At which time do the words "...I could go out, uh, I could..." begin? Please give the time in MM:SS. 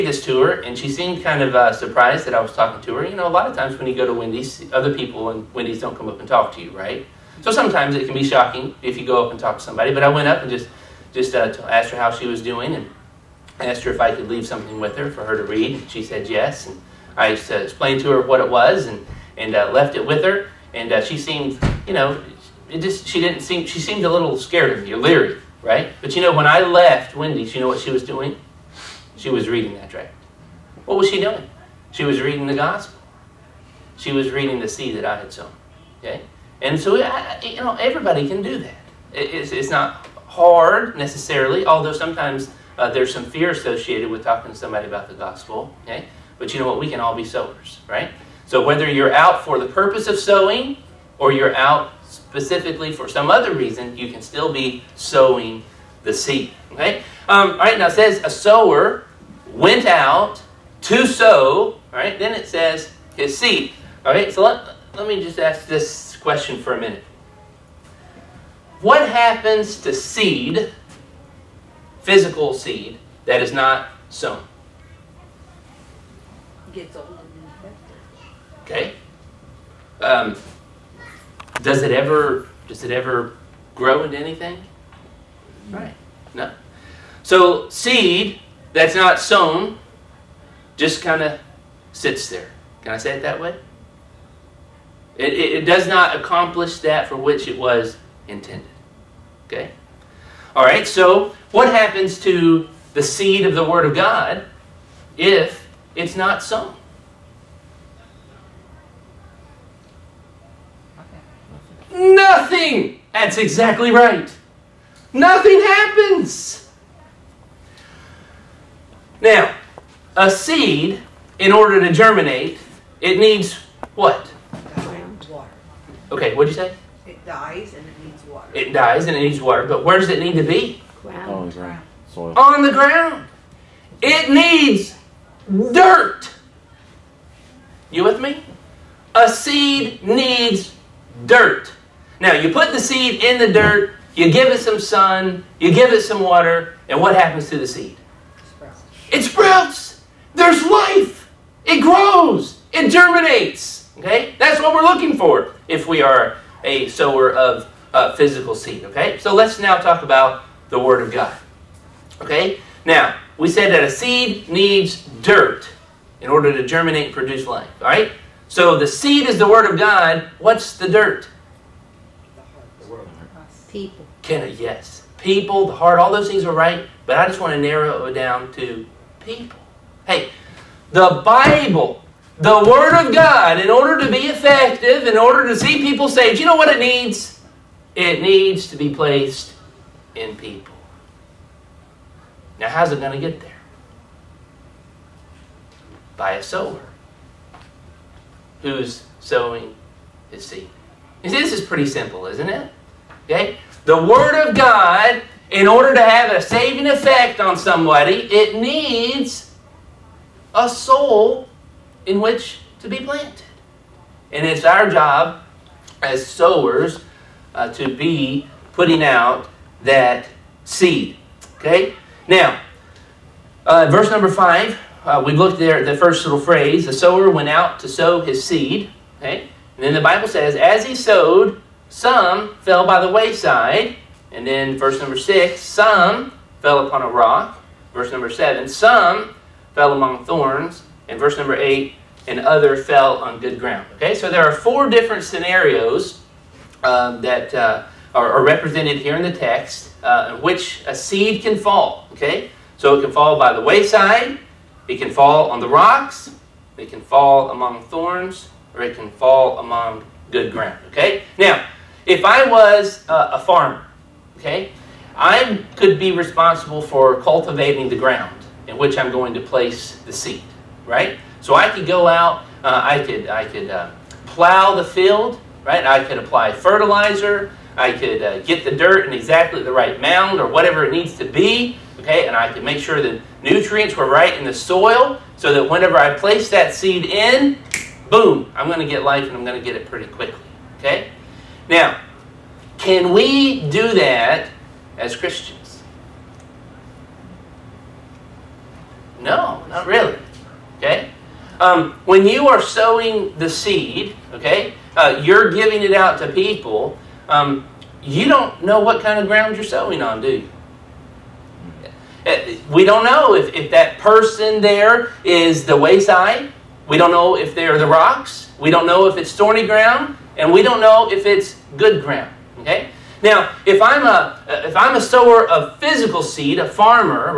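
04:31.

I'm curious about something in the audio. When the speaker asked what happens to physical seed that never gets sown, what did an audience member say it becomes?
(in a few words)
Old and infected.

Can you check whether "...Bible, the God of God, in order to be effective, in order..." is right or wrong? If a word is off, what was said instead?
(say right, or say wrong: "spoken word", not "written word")
wrong: "Word", not "God".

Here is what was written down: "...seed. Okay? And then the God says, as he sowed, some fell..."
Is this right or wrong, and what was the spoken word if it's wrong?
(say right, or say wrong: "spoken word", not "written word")
wrong: "Bible", not "God".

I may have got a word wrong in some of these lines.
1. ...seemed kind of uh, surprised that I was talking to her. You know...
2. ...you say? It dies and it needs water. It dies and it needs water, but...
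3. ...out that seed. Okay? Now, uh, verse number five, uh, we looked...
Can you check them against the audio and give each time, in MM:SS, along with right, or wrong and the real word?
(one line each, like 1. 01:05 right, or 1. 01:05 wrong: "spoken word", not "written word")
1. 00:00 right
2. 02:06 right
3. 03:39 right.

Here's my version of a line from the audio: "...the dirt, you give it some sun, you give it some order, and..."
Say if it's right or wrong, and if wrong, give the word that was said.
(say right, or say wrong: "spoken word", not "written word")
wrong: "water", not "order".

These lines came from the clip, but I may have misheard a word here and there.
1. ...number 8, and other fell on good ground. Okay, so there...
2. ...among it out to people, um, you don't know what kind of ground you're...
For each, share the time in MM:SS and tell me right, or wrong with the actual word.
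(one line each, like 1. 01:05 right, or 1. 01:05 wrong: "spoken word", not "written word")
1. 04:01 right
2. 05:05 wrong: "giving", not "among".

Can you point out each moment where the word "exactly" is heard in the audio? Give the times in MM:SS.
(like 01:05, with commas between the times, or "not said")
01:53, 04:39.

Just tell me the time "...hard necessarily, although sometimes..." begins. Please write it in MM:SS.
00:40.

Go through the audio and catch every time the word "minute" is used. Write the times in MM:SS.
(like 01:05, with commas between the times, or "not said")
01:06.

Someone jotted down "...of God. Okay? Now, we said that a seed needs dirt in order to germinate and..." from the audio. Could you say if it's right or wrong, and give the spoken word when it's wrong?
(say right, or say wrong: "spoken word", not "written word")
right.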